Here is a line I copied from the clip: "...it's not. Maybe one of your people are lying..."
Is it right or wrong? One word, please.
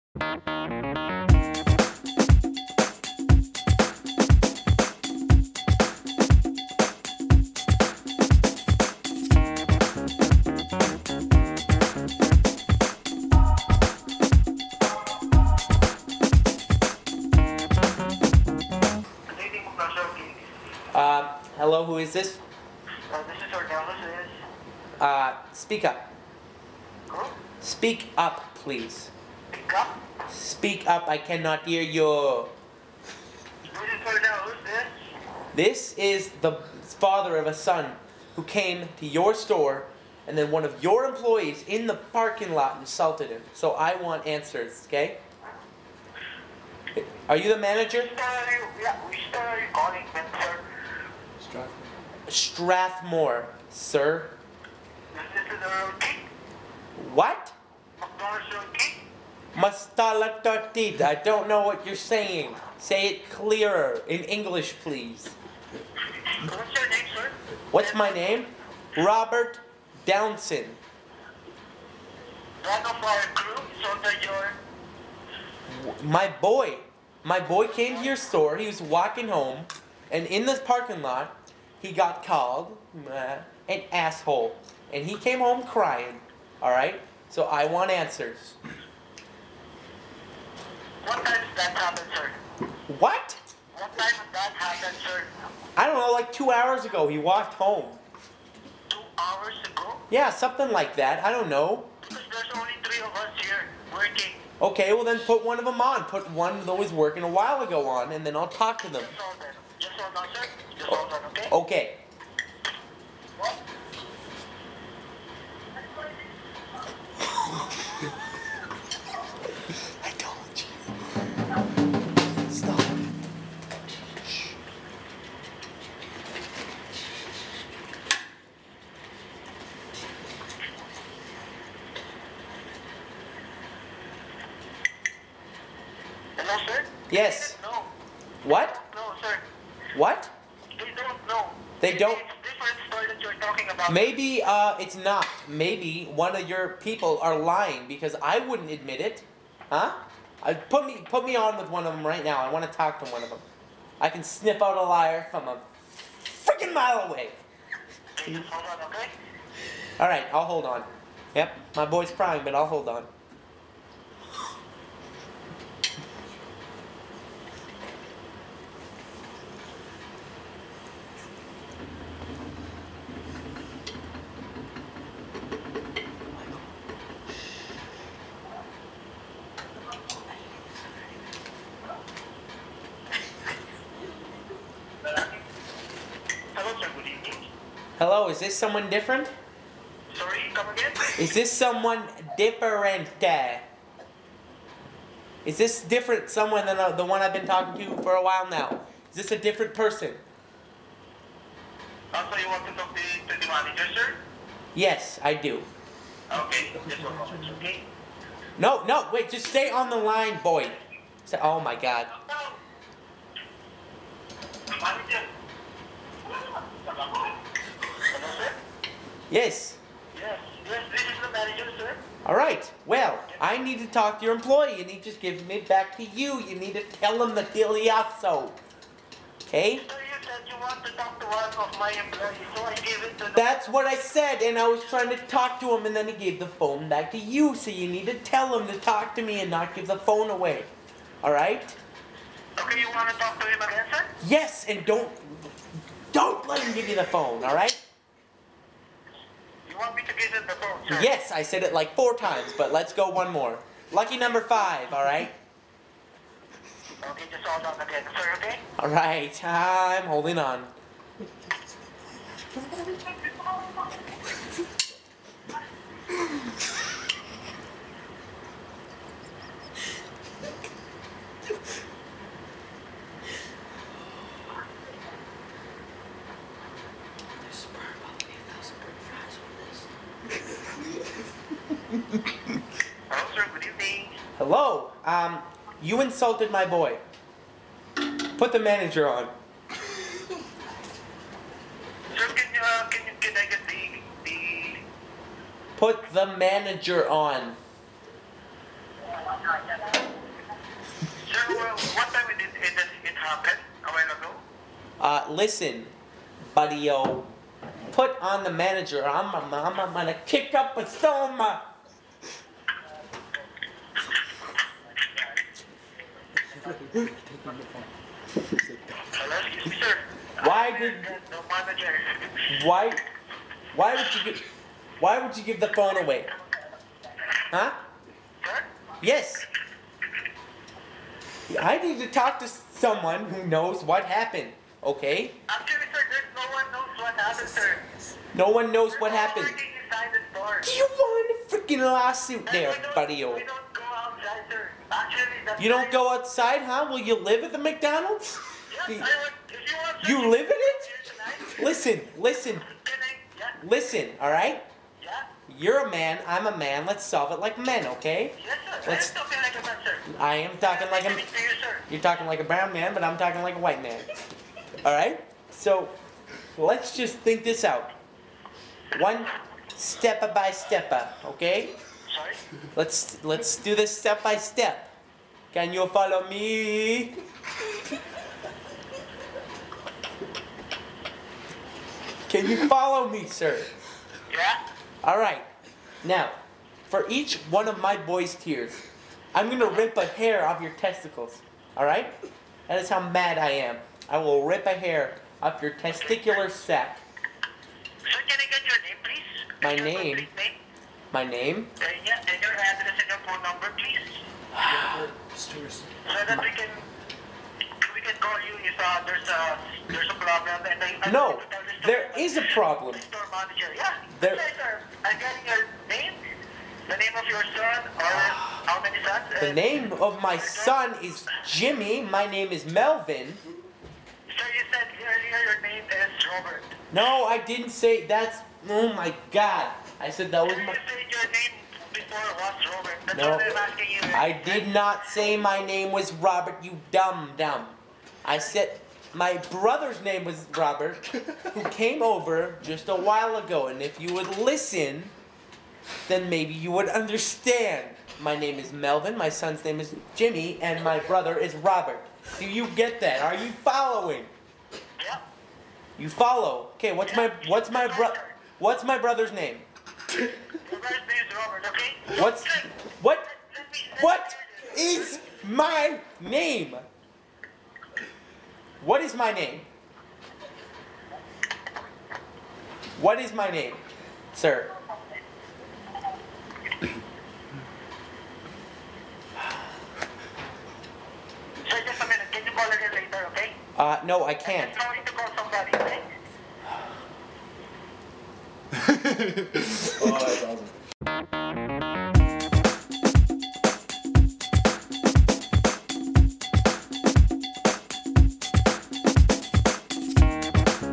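right.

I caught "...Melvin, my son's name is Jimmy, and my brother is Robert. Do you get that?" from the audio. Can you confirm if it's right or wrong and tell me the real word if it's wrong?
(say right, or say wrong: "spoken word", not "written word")
right.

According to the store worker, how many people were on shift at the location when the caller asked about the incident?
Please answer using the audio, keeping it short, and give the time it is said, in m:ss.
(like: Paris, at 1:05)
3, at 1:42.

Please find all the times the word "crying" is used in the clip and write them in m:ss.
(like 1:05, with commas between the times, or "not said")
1:25, 2:42.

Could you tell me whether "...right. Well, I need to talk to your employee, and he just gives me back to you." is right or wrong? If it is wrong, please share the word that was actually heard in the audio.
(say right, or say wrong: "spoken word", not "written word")
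right.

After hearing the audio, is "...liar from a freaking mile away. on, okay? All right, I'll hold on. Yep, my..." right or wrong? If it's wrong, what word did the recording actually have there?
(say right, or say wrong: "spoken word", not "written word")
right.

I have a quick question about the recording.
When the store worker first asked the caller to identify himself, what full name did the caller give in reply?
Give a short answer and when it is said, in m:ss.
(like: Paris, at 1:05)
Robert Downson, at 1:08.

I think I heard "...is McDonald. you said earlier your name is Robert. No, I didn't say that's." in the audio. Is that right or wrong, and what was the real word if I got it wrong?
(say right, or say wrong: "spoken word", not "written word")
wrong: "Melvin", not "McDonald".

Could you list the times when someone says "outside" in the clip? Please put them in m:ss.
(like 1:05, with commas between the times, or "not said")
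5:46.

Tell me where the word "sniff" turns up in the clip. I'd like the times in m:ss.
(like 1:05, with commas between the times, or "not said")
2:34.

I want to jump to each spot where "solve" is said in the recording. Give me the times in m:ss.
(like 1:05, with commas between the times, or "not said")
5:57.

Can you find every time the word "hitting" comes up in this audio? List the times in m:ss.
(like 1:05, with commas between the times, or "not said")
not said.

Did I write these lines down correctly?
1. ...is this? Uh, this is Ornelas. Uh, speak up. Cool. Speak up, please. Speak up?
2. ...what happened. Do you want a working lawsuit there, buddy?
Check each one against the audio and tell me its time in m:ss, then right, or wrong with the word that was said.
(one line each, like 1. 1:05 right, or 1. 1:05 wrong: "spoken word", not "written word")
1. 0:21 right
2. 5:38 wrong: "freaking", not "working".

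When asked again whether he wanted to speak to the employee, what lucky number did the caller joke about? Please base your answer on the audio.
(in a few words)
5.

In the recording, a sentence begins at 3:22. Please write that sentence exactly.
Also, you want to talk to, the manager, sir?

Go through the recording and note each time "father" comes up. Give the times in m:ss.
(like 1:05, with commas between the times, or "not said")
0:36.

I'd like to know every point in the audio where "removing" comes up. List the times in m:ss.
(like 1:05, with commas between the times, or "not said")
not said.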